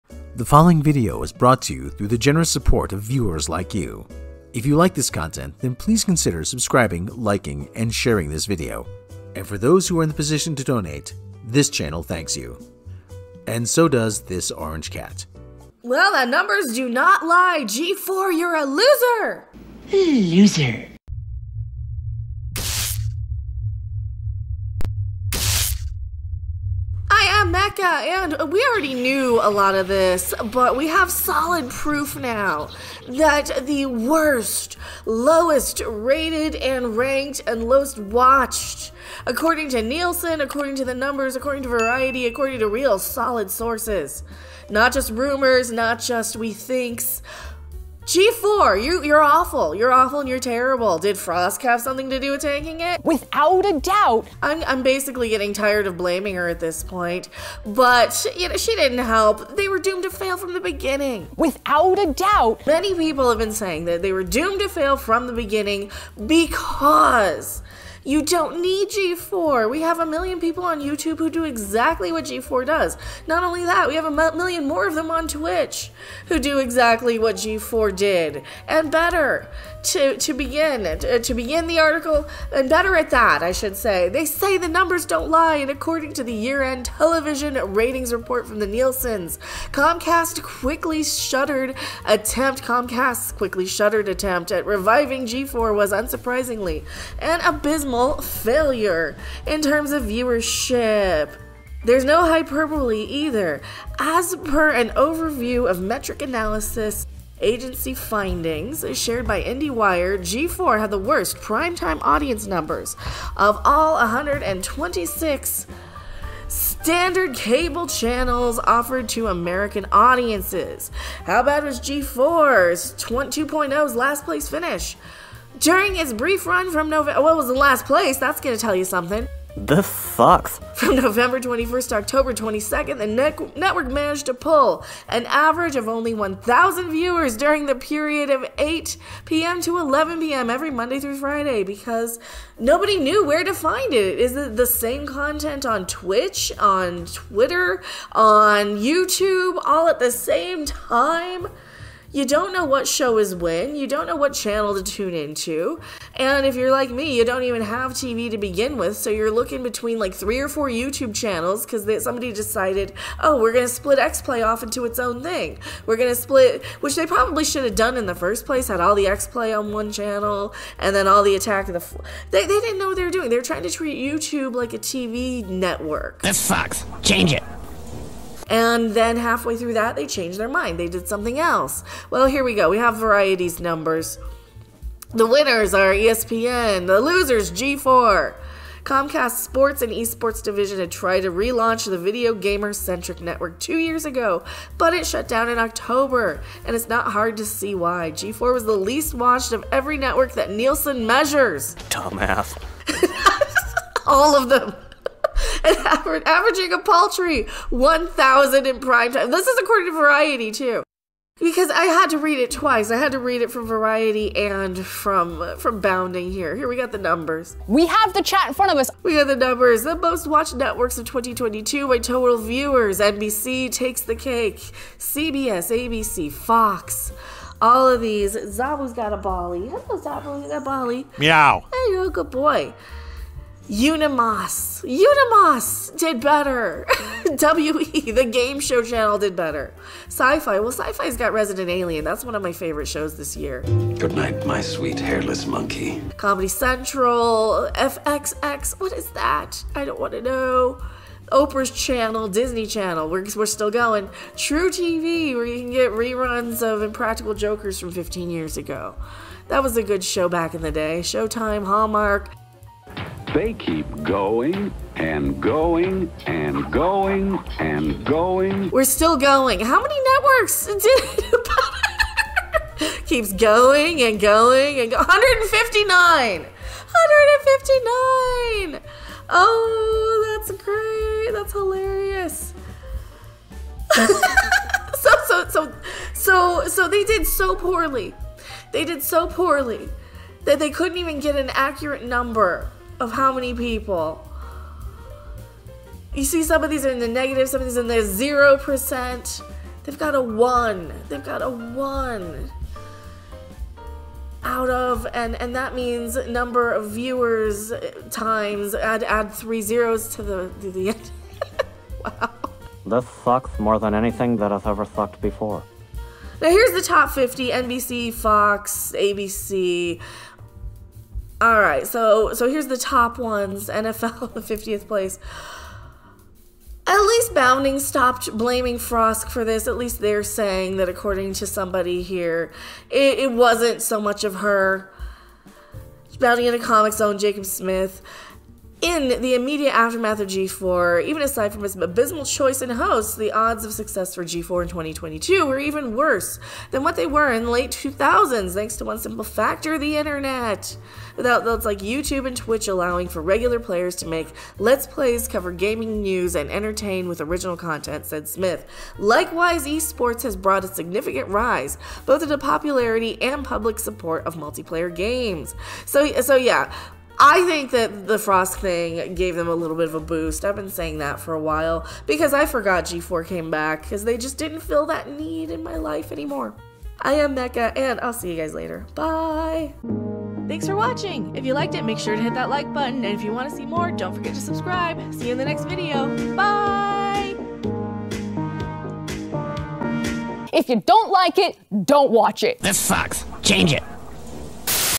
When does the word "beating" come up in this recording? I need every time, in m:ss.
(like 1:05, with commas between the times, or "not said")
not said.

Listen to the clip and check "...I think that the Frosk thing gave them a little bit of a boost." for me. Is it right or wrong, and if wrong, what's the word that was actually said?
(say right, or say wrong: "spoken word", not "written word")
right.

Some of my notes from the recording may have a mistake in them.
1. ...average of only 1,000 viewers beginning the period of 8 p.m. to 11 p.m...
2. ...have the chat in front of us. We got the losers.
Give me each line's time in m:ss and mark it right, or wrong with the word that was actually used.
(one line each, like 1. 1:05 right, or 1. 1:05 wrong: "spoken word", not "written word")
1. 2:15 wrong: "during", not "beginning"
2. 3:37 wrong: "numbers", not "losers".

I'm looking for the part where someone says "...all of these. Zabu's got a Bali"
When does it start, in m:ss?
3:47.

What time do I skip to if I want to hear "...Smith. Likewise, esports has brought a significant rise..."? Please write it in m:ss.
5:58.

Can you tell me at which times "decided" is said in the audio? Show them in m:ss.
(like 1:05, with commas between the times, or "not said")
2:42.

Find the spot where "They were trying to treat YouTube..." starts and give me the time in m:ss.
2:53.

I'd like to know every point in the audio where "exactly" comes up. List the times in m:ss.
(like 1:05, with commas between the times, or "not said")
1:11, 1:16.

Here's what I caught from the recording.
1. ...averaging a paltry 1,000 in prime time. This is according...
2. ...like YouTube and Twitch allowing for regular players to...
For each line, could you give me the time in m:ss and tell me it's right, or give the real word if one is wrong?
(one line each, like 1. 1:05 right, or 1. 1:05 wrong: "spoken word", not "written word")
1. 3:26 right
2. 5:51 right.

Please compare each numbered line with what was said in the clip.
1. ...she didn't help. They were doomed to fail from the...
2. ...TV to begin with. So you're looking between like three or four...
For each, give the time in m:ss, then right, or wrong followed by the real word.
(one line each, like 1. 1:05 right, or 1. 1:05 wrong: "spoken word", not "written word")
1. 0:58 right
2. 2:37 right.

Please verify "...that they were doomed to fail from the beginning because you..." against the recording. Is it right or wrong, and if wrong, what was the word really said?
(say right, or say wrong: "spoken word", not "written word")
right.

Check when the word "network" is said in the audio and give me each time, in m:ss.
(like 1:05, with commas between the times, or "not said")
2:13, 2:55, 3:13, 3:19, 3:40, 4:30.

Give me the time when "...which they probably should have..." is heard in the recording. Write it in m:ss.
2:46.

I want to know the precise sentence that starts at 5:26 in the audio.
At least Bounding stopped blaming Frosk for this.